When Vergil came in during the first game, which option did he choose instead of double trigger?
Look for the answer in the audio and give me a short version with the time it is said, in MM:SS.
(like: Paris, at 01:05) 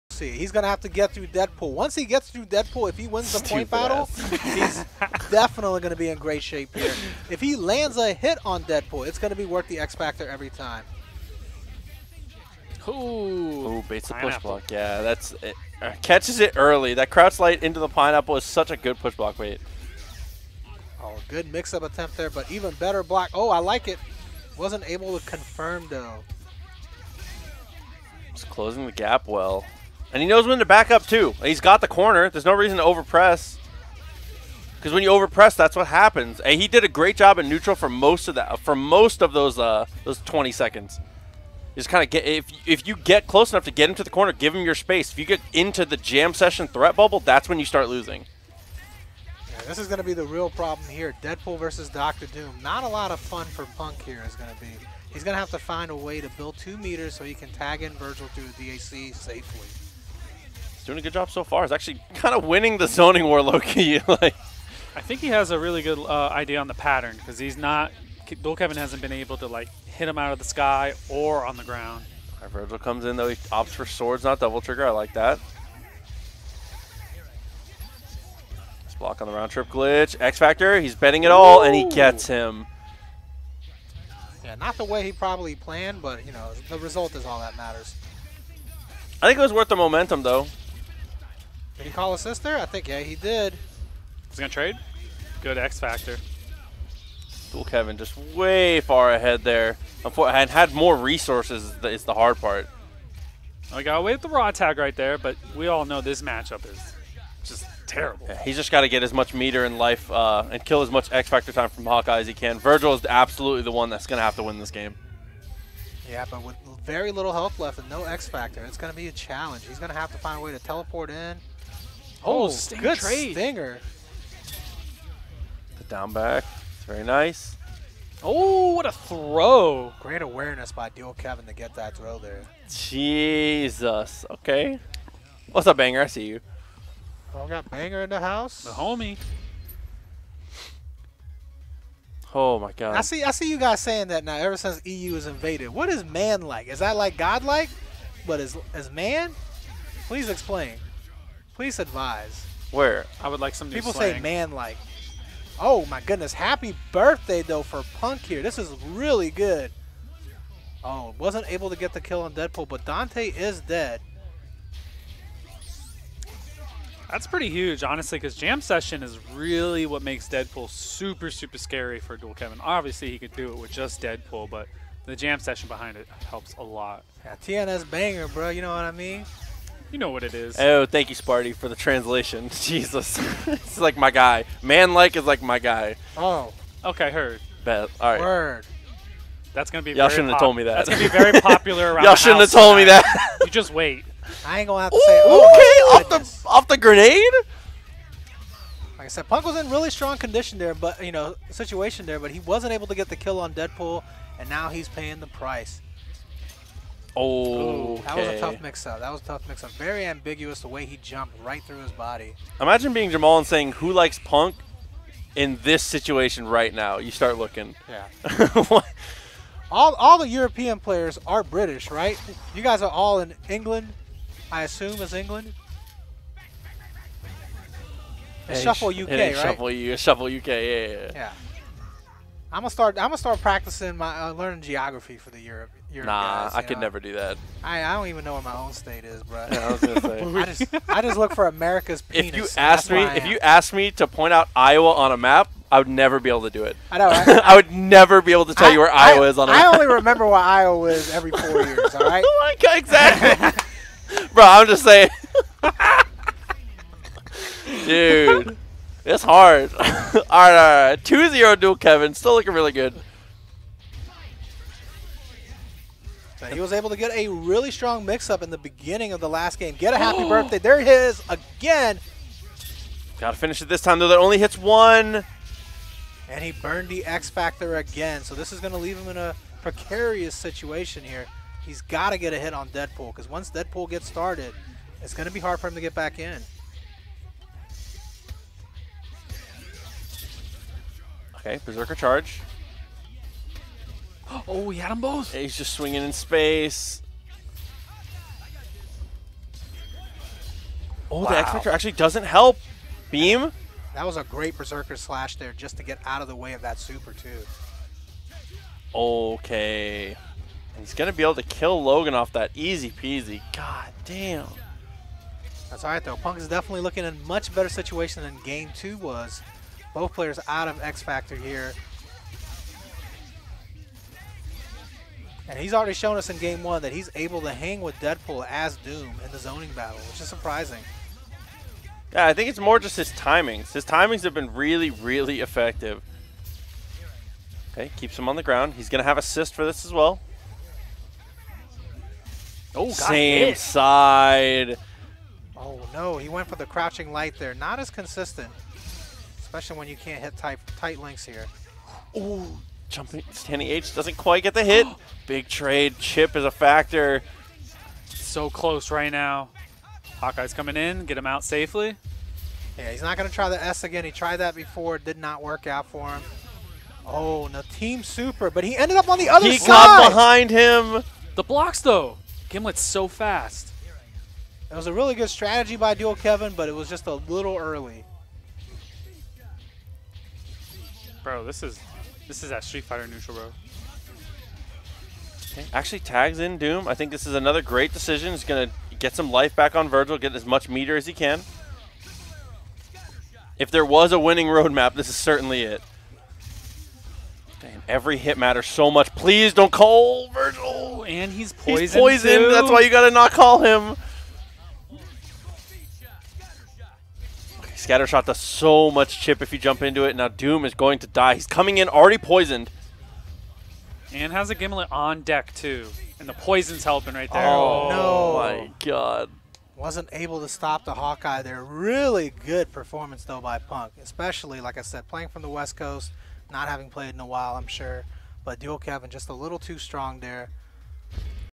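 Swords, at 01:13.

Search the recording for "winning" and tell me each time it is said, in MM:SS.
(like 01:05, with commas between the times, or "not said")
01:02, 06:34.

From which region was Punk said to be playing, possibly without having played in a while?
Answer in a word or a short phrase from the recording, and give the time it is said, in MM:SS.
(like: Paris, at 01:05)
West Coast, at 07:05.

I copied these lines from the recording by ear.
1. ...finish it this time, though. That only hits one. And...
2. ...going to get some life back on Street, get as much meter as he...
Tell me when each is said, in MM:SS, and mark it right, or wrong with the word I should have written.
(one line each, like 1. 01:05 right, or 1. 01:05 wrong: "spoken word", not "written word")
1. 04:33 right
2. 06:28 wrong: "Vergil", not "Street".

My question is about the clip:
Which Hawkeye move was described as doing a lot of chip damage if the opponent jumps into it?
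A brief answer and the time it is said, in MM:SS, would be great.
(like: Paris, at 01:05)
Scattershot, at 06:47.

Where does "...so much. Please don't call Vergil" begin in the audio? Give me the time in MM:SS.
06:38.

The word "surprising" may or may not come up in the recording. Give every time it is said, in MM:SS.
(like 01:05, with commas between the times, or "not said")
05:30.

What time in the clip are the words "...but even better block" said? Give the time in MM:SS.
00:22.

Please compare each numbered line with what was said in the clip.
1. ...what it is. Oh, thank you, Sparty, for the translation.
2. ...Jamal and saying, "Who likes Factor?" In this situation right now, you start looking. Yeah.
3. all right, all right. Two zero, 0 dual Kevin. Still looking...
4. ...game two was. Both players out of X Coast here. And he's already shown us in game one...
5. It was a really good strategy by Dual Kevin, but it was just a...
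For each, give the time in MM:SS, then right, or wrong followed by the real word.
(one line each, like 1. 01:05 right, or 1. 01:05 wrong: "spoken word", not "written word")
1. 03:00 right
2. 03:33 wrong: "Punk", not "Factor"
3. 04:19 right
4. 05:18 wrong: "Factor", not "Coast"
5. 06:14 right.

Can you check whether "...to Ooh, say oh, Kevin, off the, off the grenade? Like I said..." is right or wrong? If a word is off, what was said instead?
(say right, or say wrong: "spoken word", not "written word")
wrong: "Okay", not "Kevin".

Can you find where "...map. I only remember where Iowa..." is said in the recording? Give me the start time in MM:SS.
04:09.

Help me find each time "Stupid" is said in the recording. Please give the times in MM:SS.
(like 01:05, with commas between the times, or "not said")
00:03.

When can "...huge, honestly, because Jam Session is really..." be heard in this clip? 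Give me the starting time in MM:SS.
02:47.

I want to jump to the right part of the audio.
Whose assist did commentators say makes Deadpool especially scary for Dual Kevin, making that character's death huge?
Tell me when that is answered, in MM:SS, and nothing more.
02:42.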